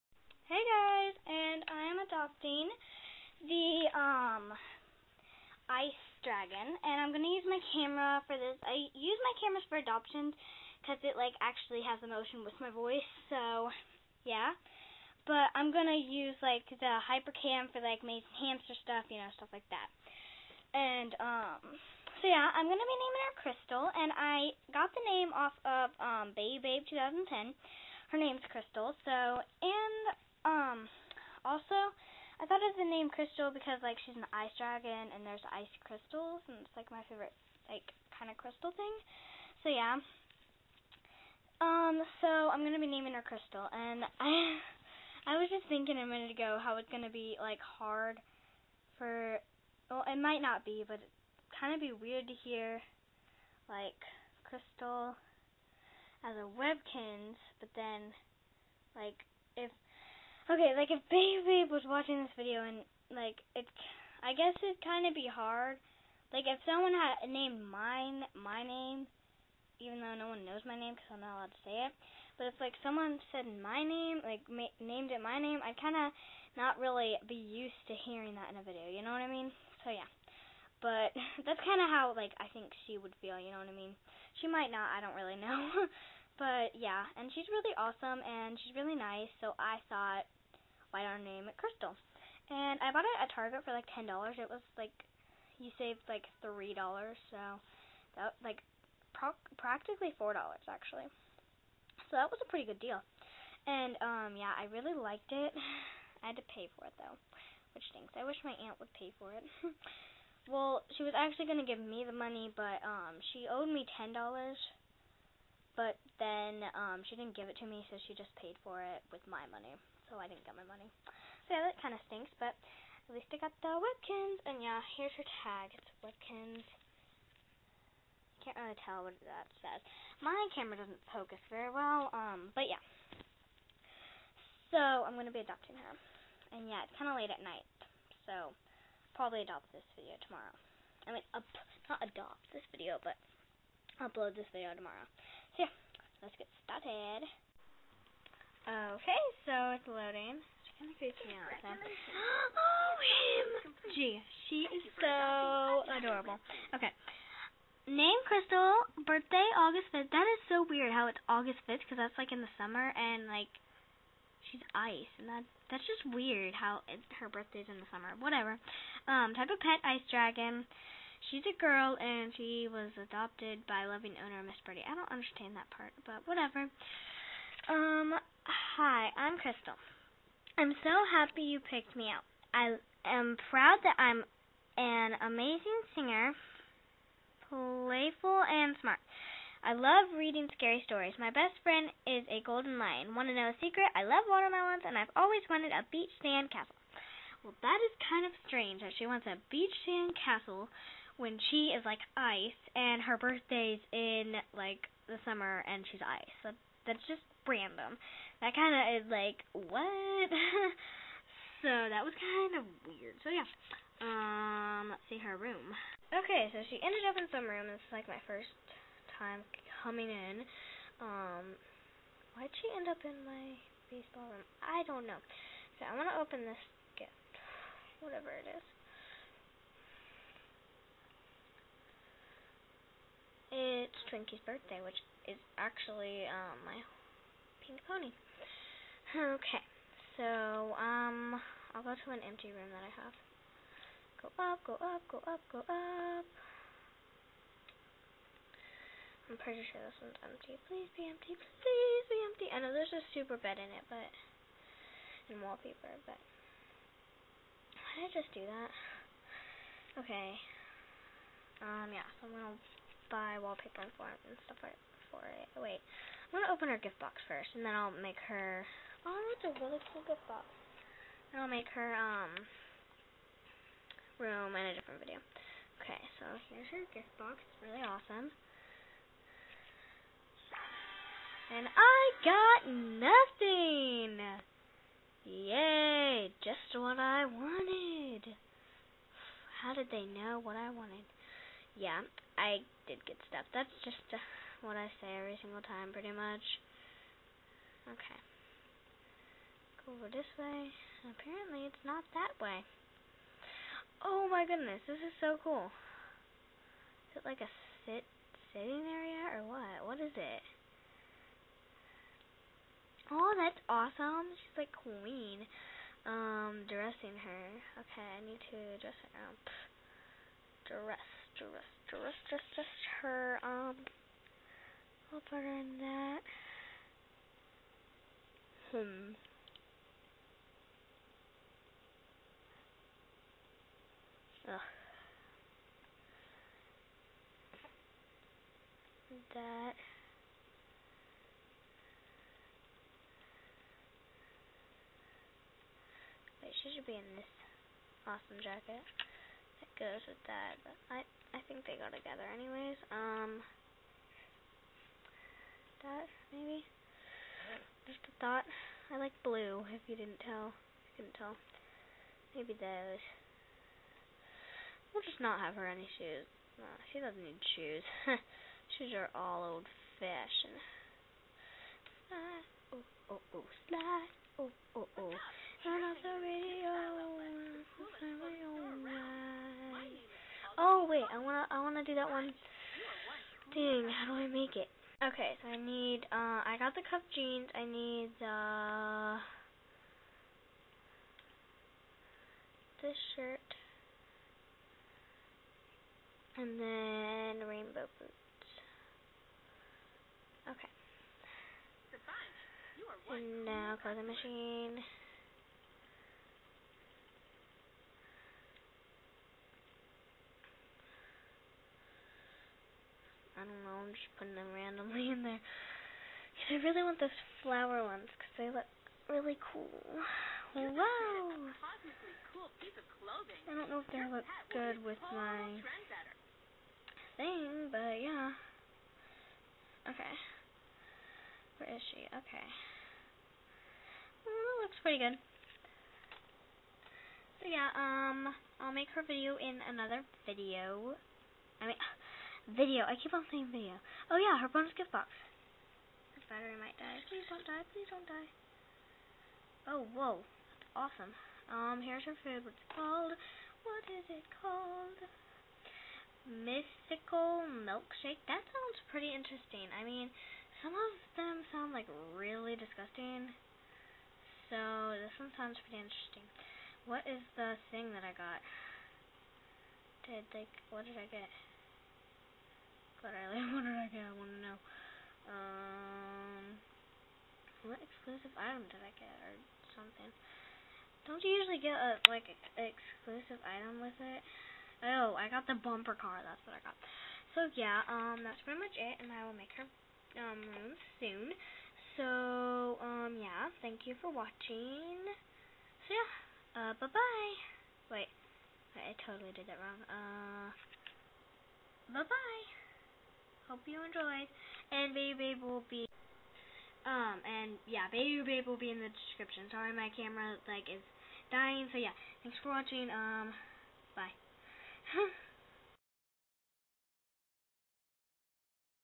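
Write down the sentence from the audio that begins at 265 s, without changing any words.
Wait, I'm gonna open her gift box first, and then I'll make her Oh, that's a really cool gift box.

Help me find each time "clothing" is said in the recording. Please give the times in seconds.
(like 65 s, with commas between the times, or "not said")
403 s.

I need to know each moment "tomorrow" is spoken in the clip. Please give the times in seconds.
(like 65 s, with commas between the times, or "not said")
140 s, 144 s.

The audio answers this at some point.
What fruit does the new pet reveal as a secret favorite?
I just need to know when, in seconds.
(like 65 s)
194 s.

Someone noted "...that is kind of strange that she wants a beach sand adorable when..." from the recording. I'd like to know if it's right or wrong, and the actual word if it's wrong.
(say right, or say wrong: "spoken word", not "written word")
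wrong: "castle", not "adorable".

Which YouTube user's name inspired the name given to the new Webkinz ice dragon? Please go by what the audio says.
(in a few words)
bayoubabe 2010.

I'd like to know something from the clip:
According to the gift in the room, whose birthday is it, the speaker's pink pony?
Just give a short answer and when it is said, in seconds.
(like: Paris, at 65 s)
Twinkie, at 234 s.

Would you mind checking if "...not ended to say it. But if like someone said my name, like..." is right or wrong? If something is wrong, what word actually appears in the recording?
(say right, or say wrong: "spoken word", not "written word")
wrong: "allowed", not "ended".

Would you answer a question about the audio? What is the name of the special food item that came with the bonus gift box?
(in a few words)
mystical milkshake.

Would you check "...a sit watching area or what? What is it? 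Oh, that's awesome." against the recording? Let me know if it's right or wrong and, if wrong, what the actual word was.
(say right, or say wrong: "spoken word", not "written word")
wrong: "sitting", not "watching".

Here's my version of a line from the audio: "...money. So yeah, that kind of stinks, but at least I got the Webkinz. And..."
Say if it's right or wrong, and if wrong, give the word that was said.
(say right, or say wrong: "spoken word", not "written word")
right.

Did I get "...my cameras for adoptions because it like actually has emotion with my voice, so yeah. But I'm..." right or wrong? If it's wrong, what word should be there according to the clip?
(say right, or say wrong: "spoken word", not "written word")
right.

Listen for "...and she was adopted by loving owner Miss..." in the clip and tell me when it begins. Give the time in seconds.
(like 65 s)
171 s.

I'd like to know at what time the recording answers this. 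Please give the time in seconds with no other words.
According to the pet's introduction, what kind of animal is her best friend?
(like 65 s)
192 s.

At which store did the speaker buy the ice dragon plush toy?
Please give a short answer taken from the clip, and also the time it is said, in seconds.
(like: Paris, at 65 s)
Target, at 93 s.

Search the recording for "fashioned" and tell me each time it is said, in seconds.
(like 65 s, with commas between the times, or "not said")
369 s.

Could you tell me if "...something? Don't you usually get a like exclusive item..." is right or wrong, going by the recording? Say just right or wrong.
right.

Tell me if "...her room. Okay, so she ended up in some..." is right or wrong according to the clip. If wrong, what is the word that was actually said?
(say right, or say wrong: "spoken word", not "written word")
right.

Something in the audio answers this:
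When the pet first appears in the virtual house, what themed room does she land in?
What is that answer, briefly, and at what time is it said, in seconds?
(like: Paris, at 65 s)
baseball room, at 223 s.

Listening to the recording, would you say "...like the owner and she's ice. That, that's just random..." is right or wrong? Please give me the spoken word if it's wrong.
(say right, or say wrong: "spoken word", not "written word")
wrong: "summer", not "owner".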